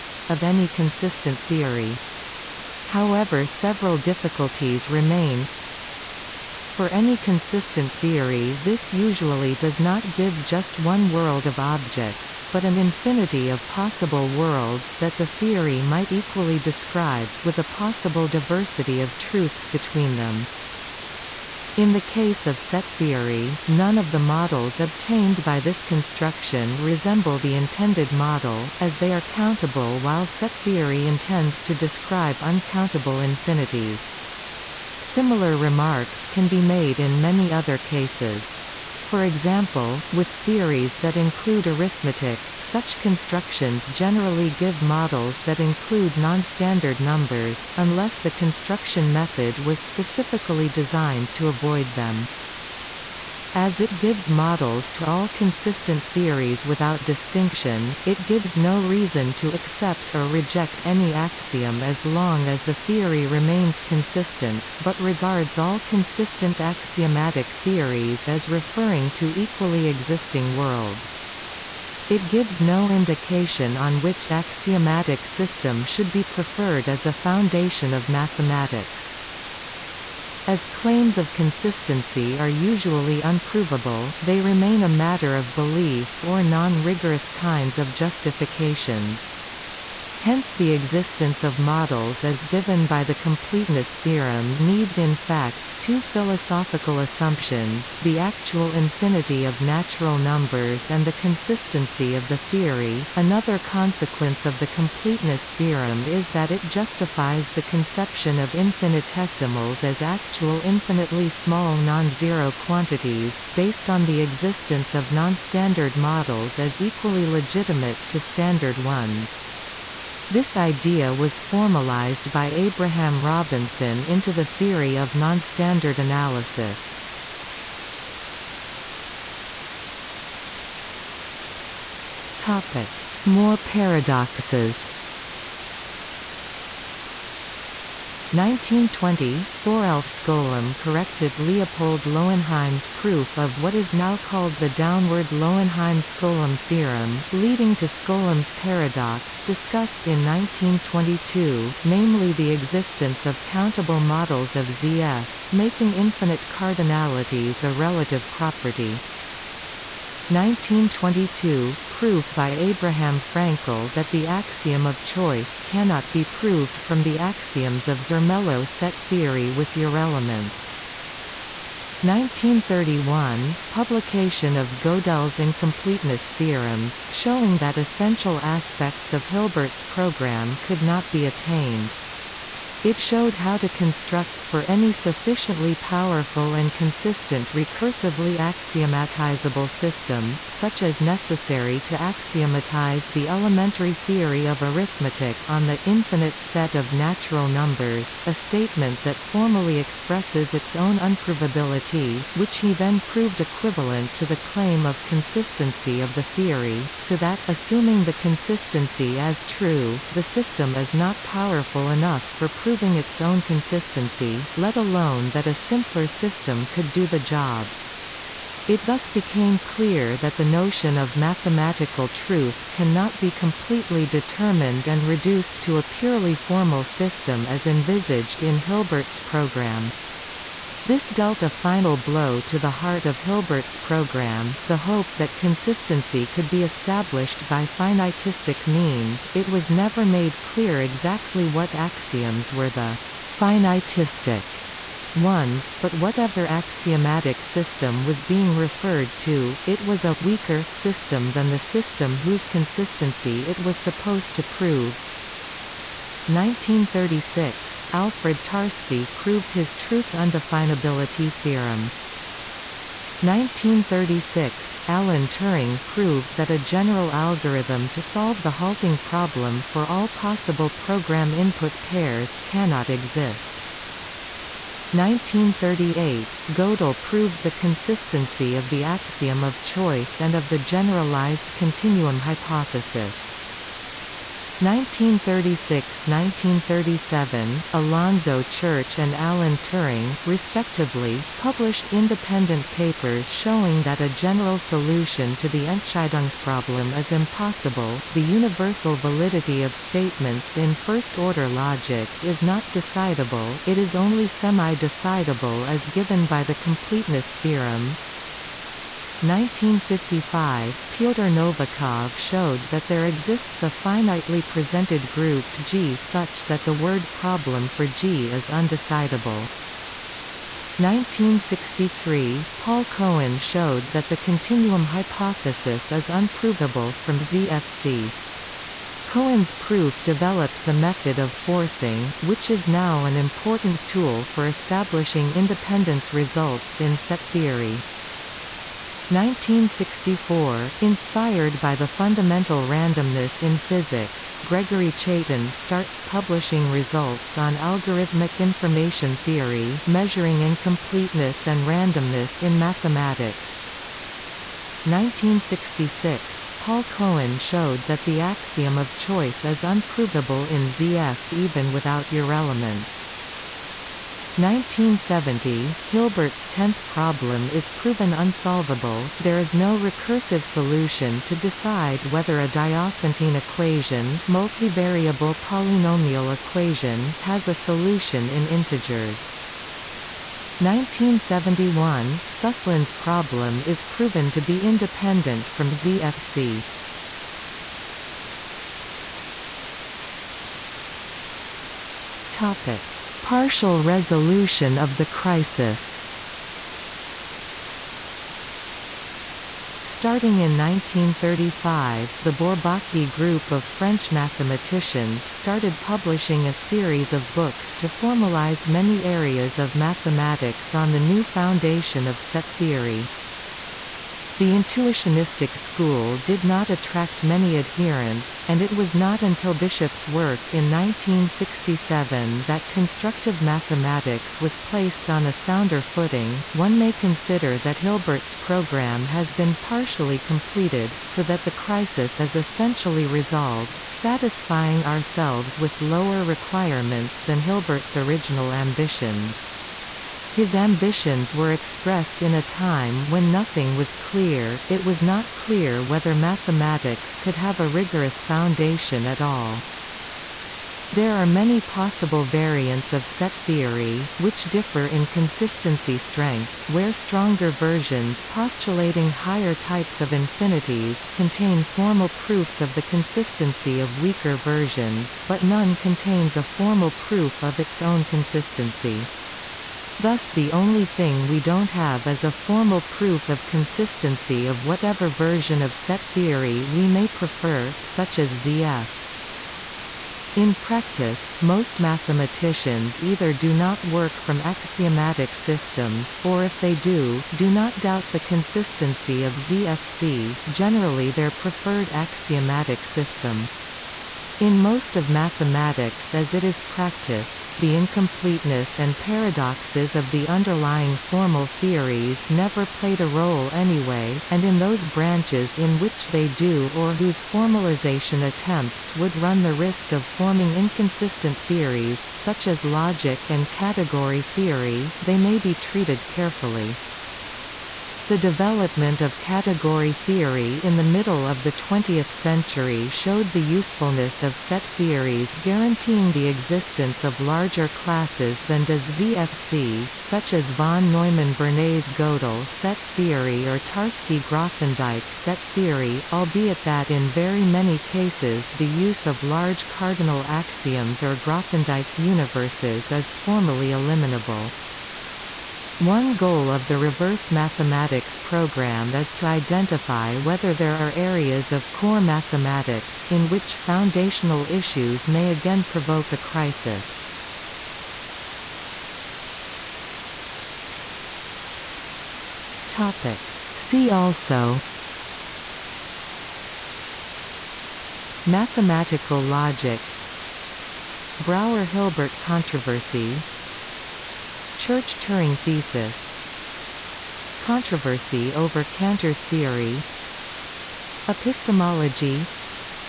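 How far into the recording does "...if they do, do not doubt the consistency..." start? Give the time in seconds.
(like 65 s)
486 s.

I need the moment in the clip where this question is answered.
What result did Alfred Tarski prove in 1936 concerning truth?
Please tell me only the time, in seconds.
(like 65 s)
259 s.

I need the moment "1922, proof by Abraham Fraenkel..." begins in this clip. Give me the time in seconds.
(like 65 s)
160 s.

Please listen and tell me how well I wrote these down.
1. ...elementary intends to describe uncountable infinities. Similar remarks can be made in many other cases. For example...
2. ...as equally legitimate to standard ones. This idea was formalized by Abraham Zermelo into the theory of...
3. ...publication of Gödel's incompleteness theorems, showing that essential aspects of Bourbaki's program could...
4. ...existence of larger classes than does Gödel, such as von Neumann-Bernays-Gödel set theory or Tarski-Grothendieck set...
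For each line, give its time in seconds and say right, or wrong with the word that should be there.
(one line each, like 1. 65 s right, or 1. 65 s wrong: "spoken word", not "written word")
1. 30 s wrong: "theory", not "elementary"
2. 116 s wrong: "Robinson", not "Zermelo"
3. 173 s wrong: "Hilbert", not "Bourbaki"
4. 526 s wrong: "ZFC", not "Gödel".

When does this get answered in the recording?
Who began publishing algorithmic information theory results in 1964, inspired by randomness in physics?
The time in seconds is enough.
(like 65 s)
344 s.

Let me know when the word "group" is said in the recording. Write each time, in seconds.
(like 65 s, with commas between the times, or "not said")
315 s, 403 s.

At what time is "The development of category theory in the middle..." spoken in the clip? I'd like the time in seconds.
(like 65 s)
518 s.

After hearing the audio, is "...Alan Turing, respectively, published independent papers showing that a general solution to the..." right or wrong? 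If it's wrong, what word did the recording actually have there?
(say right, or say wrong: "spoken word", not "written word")
right.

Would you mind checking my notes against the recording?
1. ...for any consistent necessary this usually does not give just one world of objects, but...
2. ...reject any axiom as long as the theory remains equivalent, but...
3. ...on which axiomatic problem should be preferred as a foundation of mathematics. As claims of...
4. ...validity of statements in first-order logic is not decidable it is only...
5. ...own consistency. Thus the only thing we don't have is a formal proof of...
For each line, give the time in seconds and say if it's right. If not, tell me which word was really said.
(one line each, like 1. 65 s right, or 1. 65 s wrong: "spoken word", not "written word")
1. 6 s wrong: "theory", not "necessary"
2. 60 s wrong: "consistent", not "equivalent"
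3. 73 s wrong: "system", not "problem"
4. 298 s right
5. 467 s right.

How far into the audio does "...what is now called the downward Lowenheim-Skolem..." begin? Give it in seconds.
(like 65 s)
143 s.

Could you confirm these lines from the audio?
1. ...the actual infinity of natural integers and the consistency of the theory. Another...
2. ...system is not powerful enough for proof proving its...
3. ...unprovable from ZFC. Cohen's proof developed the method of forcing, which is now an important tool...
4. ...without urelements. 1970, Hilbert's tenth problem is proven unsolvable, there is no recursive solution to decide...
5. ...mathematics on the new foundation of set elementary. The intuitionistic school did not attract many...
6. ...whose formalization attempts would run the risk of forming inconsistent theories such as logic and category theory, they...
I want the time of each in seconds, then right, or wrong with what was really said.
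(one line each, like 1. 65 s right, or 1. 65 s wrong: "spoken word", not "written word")
1. 98 s wrong: "numbers", not "integers"
2. 210 s right
3. 326 s right
4. 361 s right
5. 409 s wrong: "theory", not "elementary"
6. 506 s right.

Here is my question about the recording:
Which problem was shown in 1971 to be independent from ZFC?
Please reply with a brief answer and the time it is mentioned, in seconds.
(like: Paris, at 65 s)
Suslin's problem, at 382 s.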